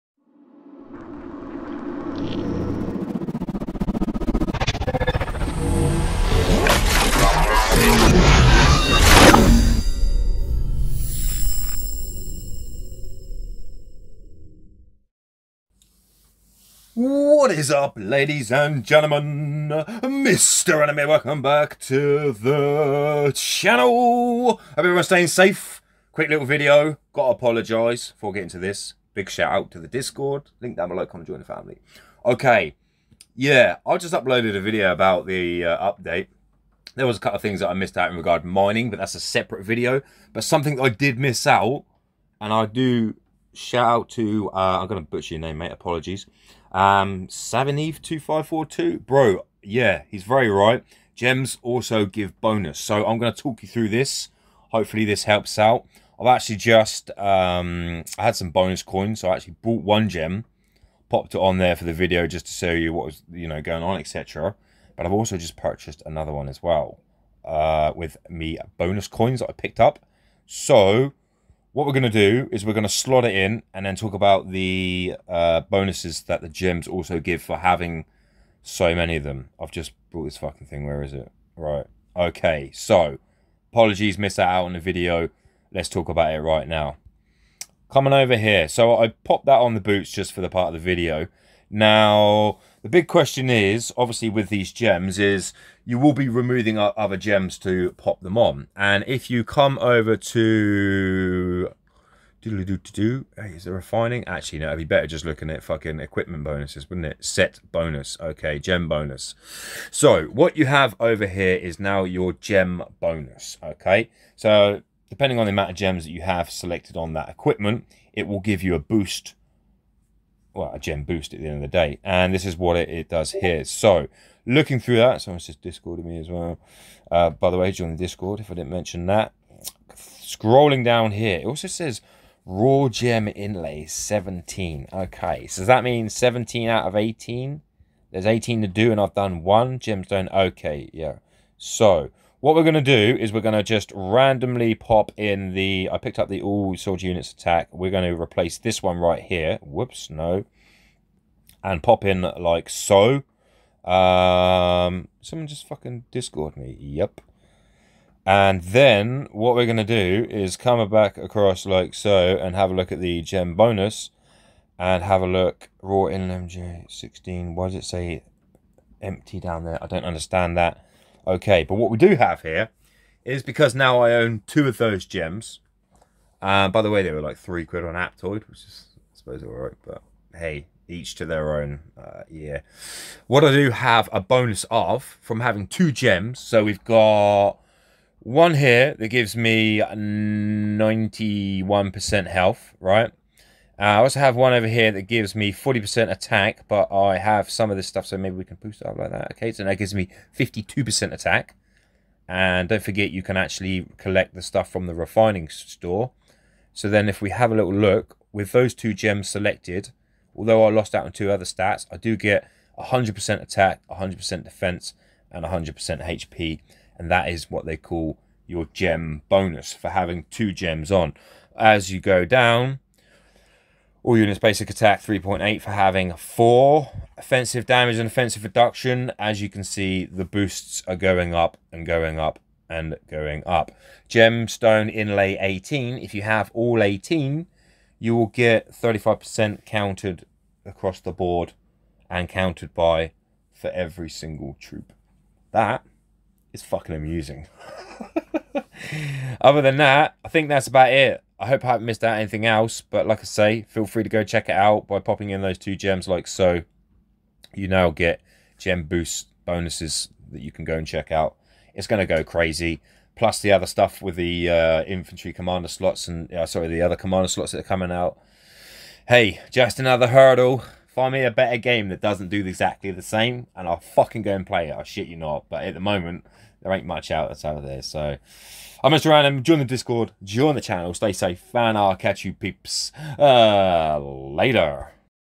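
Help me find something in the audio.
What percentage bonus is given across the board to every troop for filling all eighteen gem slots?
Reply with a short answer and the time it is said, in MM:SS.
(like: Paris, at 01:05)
35%, at 03:58.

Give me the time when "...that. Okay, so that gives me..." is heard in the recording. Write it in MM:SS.
03:19.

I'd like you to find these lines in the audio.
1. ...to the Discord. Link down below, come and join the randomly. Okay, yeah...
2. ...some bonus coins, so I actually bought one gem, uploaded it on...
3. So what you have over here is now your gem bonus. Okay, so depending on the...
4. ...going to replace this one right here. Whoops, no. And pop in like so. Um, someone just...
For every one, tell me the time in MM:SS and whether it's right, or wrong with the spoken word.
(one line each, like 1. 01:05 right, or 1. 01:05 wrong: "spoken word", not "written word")
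1. 00:29 wrong: "family", not "randomly"
2. 00:58 wrong: "popped", not "uploaded"
3. 01:49 right
4. 02:27 right.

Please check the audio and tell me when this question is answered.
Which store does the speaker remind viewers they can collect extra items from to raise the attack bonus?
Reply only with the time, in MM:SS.
03:24.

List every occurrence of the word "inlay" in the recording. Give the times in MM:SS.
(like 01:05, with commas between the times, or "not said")
02:13, 03:54.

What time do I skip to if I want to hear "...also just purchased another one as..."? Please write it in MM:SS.
01:05.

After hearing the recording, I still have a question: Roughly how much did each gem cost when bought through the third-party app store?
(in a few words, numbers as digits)
3 quid.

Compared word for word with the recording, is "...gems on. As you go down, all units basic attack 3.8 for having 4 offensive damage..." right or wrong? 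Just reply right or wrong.
right.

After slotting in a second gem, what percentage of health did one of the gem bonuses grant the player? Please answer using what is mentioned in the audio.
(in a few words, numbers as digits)
91%.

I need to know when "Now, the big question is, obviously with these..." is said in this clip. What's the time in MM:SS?
01:31.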